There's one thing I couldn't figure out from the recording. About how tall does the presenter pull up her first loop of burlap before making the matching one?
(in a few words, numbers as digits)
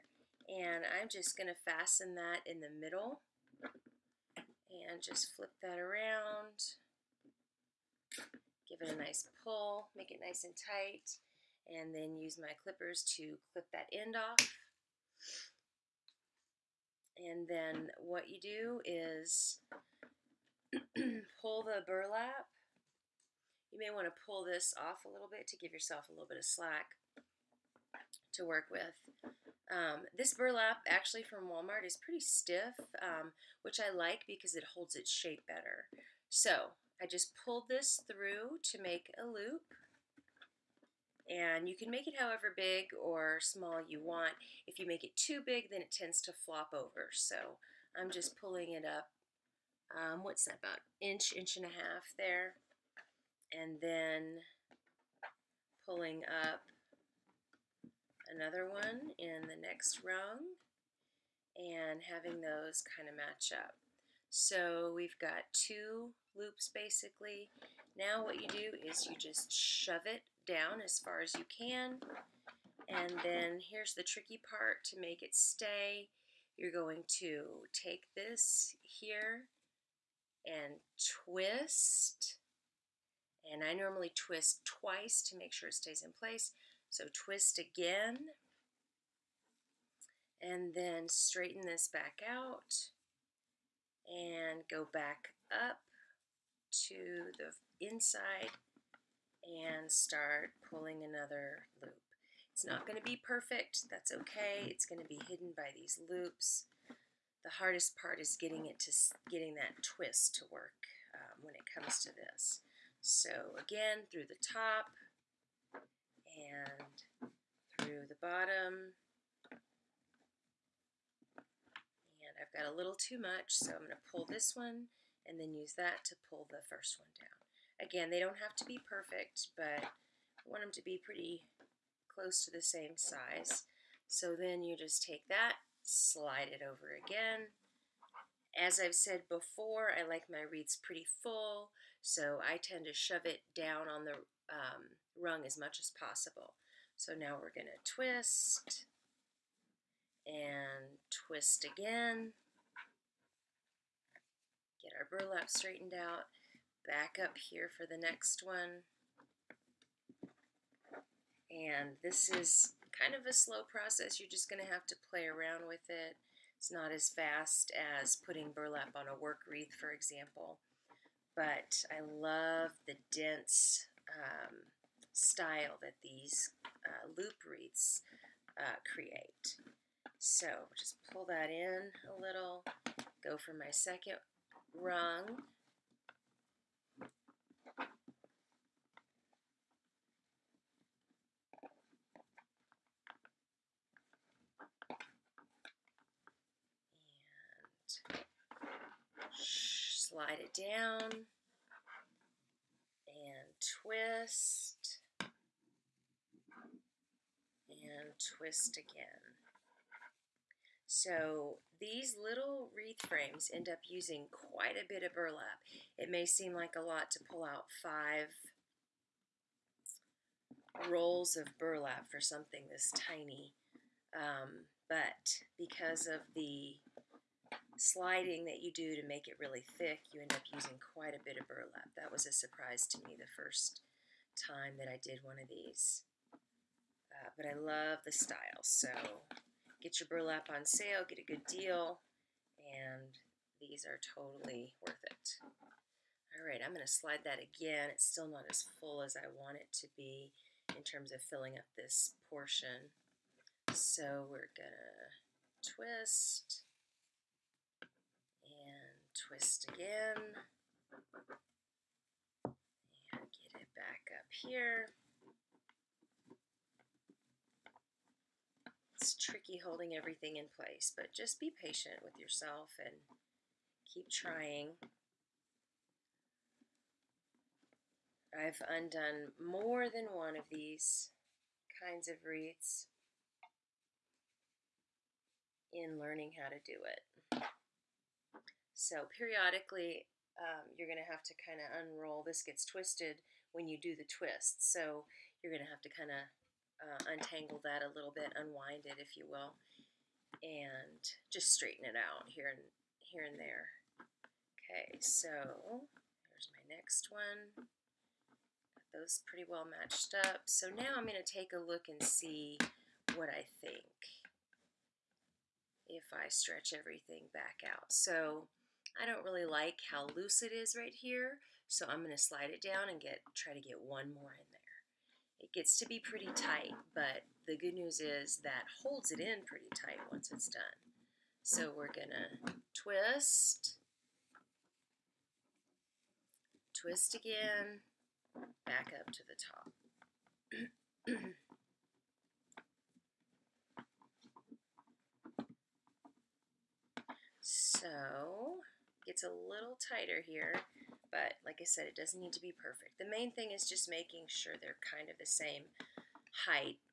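inch, inch and a half.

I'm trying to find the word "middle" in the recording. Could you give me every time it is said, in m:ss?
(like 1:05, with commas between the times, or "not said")
0:02.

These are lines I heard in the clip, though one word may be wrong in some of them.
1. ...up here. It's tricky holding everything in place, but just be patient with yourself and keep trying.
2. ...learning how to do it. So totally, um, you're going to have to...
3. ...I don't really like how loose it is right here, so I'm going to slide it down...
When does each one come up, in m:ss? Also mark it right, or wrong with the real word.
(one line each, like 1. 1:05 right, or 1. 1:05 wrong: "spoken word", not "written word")
1. 4:24 right
2. 4:45 wrong: "periodically", not "totally"
3. 5:18 right.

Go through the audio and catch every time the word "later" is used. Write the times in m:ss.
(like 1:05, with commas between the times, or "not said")
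not said.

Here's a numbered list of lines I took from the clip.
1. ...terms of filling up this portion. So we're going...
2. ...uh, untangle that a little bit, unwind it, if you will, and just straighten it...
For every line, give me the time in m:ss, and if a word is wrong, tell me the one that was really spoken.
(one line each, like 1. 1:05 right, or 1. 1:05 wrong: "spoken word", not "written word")
1. 4:10 right
2. 4:56 right.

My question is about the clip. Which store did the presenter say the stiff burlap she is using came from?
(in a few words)
Walmart.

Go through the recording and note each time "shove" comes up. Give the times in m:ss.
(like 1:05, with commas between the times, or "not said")
1:09, 2:22.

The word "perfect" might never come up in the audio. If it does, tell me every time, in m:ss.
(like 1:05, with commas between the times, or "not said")
1:43, 2:08, 5:52.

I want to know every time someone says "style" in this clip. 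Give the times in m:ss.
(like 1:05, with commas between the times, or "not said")
2:55, 3:58.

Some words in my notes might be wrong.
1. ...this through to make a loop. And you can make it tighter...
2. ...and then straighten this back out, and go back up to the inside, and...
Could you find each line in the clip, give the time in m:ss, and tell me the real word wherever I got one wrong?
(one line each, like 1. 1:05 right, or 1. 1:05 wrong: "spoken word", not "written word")
1. 0:37 wrong: "however", not "tighter"
2. 1:30 right.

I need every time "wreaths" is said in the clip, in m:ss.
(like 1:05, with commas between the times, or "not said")
2:20, 2:49, 2:57, 3:32, 4:42.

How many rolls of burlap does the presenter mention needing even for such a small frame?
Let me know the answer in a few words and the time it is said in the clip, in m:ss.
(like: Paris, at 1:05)
5, at 3:37.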